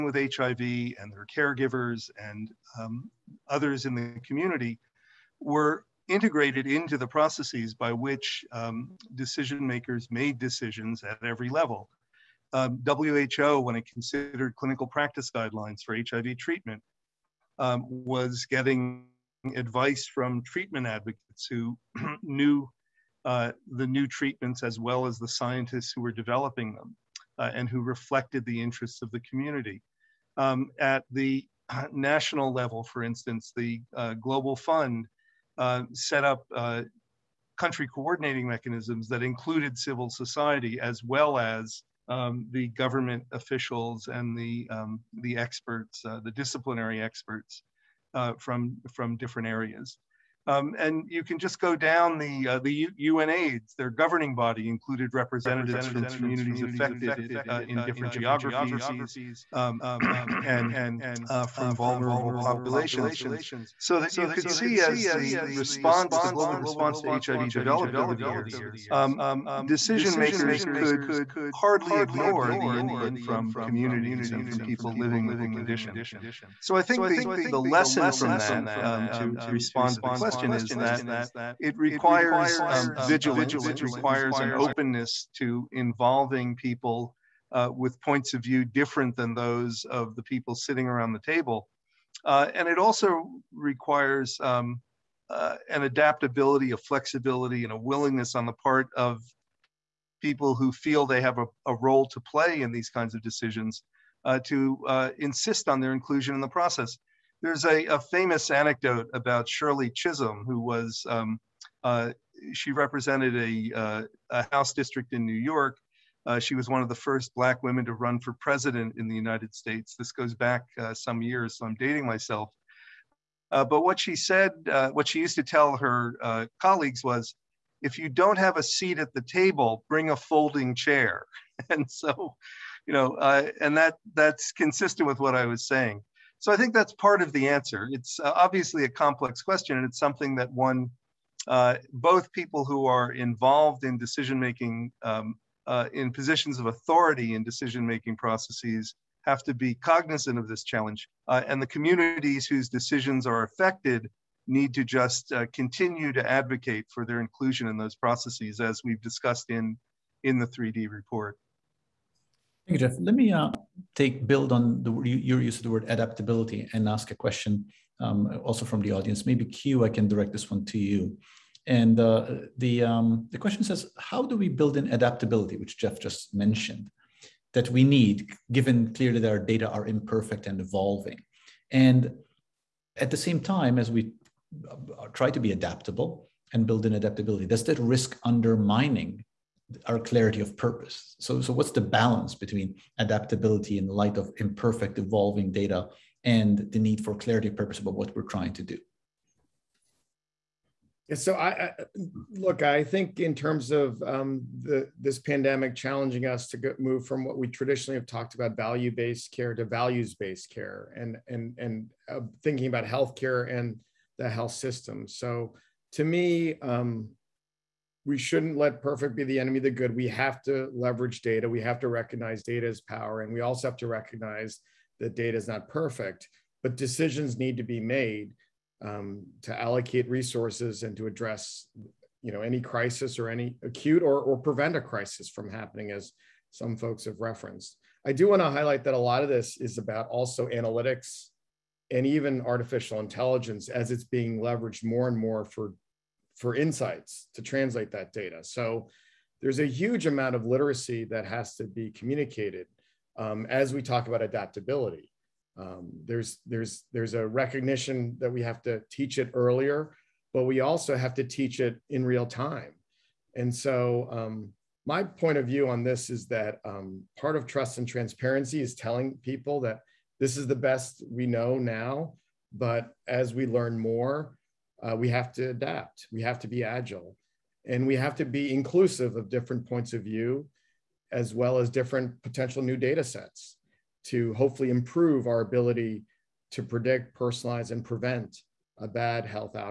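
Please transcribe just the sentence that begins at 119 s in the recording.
This goes back uh, some years, so I'm dating myself.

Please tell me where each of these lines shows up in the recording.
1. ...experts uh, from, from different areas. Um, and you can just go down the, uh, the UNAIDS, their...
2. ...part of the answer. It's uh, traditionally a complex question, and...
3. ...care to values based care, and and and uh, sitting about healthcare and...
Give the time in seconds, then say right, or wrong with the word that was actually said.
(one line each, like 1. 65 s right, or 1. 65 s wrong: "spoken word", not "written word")
1. 47 s right
2. 136 s wrong: "obviously", not "traditionally"
3. 209 s wrong: "thinking", not "sitting".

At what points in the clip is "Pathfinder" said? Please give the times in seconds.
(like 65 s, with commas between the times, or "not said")
not said.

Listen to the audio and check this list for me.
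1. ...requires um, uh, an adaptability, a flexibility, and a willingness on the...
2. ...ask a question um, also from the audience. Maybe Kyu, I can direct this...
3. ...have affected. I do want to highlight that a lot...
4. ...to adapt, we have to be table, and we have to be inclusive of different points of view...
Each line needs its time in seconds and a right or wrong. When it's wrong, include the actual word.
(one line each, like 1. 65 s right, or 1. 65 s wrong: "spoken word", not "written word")
1. 93 s right
2. 166 s right
3. 237 s wrong: "referenced", not "affected"
4. 275 s wrong: "agile", not "table".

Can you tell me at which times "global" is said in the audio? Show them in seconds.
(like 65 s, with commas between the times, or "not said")
34 s, 66 s.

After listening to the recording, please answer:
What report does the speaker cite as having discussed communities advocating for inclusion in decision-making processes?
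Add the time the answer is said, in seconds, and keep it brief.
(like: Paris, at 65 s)
3D report, at 160 s.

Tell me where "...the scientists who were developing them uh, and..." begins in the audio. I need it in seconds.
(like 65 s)
25 s.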